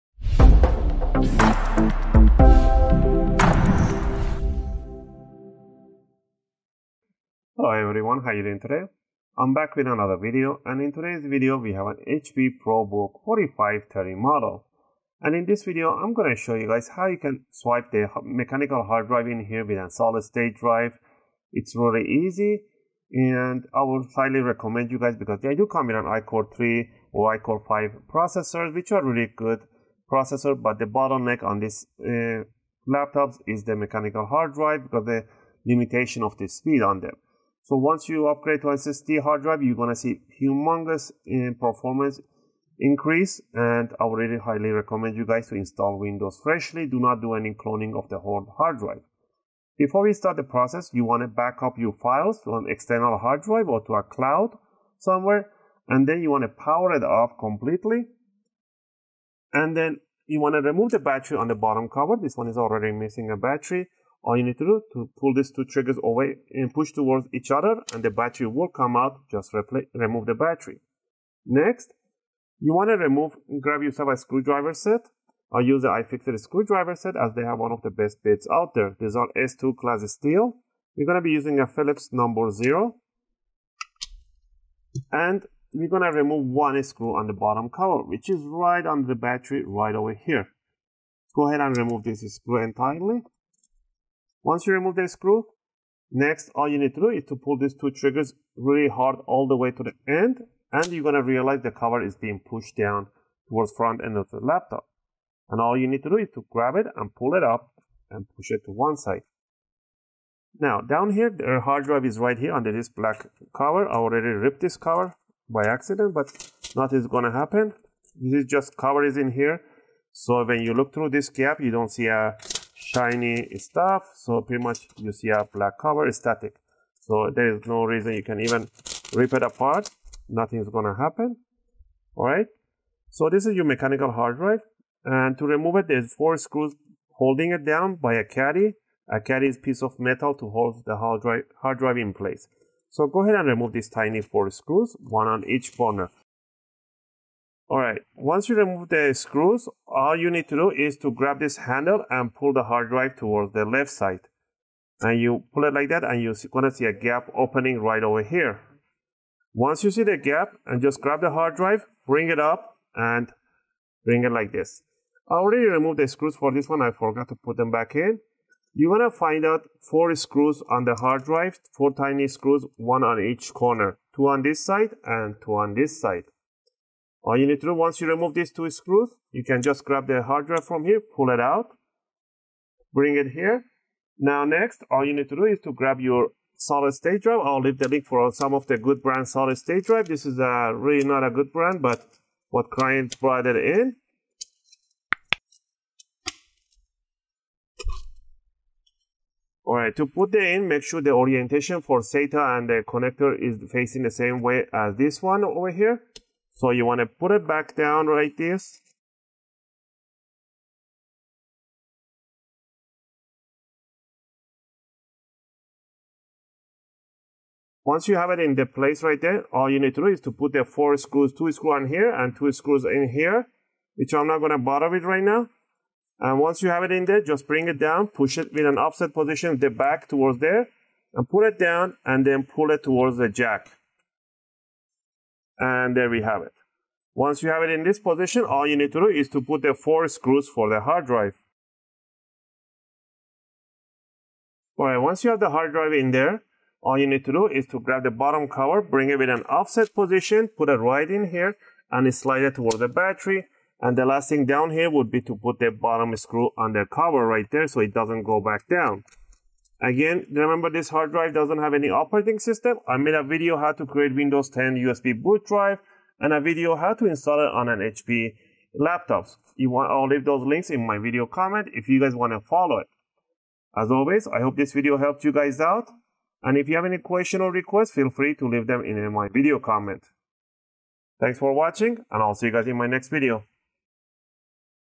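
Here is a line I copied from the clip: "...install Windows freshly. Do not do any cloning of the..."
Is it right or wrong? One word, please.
right.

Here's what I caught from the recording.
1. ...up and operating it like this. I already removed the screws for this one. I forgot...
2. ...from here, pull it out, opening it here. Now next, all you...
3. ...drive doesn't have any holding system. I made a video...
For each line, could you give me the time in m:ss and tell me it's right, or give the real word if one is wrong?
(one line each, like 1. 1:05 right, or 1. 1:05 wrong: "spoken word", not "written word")
1. 2:42 wrong: "bring", not "operating"
2. 3:00 wrong: "bring", not "opening"
3. 4:21 wrong: "operating", not "holding".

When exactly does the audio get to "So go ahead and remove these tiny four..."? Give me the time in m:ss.
2:22.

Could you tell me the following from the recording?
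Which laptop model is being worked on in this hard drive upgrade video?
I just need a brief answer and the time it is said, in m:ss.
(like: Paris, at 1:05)
HP ProBook 4530, at 0:12.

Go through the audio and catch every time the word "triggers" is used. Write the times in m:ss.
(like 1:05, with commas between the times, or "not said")
1:05, 1:37.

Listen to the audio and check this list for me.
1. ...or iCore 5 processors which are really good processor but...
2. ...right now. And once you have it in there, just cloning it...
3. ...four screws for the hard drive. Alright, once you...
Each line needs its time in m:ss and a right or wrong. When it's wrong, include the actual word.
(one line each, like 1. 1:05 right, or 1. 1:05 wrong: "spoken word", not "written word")
1. 0:27 right
2. 3:45 wrong: "bring", not "cloning"
3. 3:59 right.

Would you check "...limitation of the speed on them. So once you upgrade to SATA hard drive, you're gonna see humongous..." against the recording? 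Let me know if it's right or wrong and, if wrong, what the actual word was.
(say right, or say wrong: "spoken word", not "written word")
wrong: "SSD", not "SATA".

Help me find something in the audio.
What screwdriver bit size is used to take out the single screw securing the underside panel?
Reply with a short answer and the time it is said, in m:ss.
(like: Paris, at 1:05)
Phillips number 0, at 1:21.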